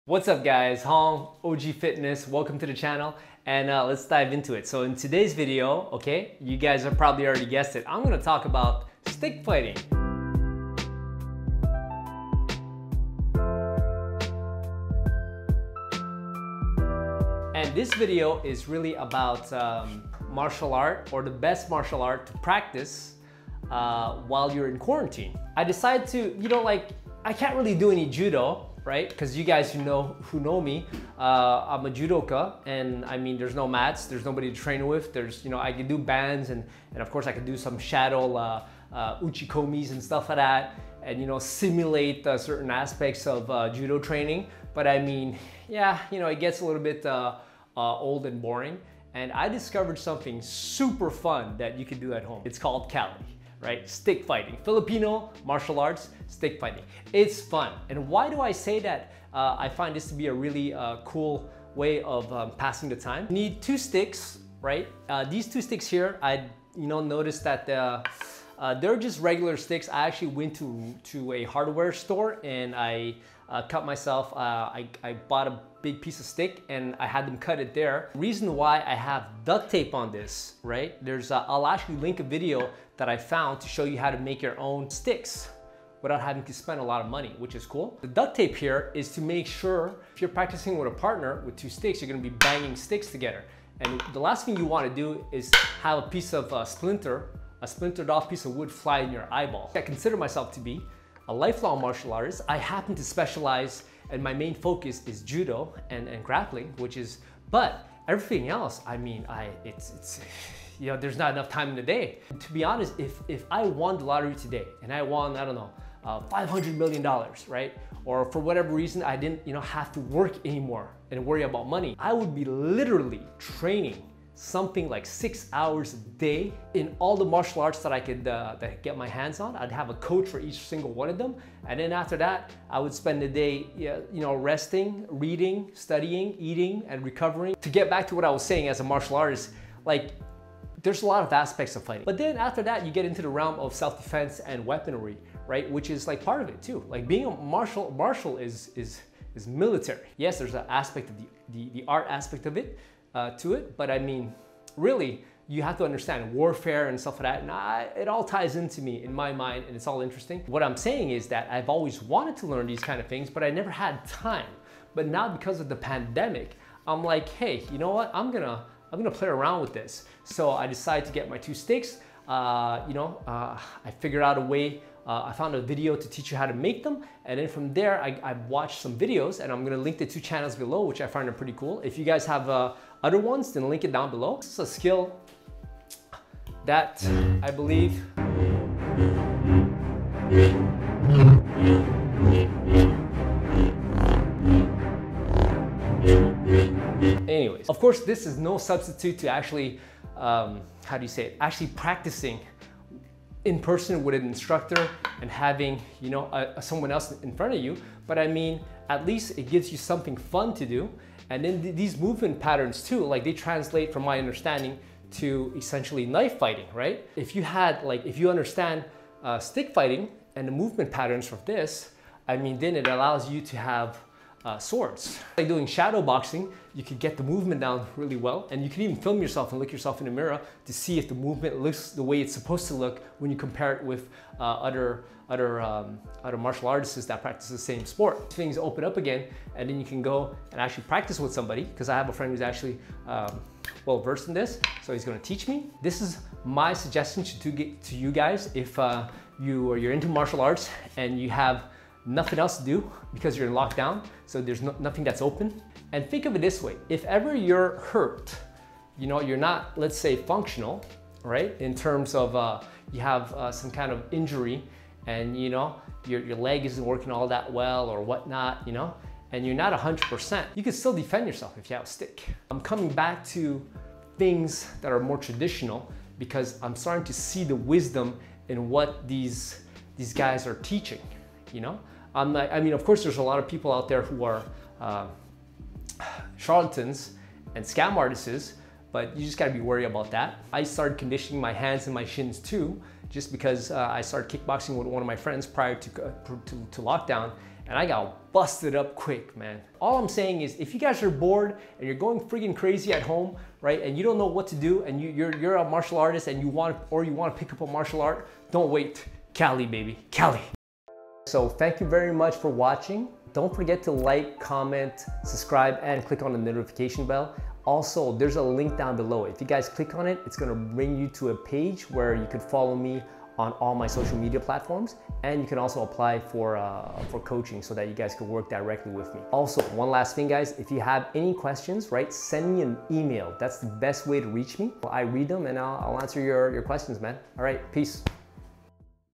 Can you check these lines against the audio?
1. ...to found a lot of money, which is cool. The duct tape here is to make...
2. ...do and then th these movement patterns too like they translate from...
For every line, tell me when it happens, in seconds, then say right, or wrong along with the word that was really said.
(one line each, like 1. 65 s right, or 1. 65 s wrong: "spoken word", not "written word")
1. 86 s wrong: "spend", not "found"
2. 210 s right.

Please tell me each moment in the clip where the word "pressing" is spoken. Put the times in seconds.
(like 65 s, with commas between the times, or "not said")
not said.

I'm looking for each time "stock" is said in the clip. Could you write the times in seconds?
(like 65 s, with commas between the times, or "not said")
not said.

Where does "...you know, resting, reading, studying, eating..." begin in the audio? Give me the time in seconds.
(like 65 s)
133 s.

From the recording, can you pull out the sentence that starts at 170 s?
So I decided to get my two sticks.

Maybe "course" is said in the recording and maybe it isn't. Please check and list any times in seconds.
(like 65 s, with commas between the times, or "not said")
37 s, 197 s, 282 s.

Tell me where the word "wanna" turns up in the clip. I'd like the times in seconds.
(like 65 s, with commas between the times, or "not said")
94 s, 307 s.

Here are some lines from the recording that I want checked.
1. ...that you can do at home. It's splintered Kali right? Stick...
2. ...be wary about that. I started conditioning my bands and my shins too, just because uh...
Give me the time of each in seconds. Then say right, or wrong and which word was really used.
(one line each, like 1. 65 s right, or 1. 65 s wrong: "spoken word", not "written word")
1. 51 s wrong: "called", not "splintered"
2. 289 s wrong: "hands", not "bands".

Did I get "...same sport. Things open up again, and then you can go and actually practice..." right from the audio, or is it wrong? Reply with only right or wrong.
right.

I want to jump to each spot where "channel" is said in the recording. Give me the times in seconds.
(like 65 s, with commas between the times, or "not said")
2 s, 180 s.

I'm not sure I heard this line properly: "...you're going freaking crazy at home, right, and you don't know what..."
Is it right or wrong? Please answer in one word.
right.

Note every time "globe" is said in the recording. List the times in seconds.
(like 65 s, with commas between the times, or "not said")
not said.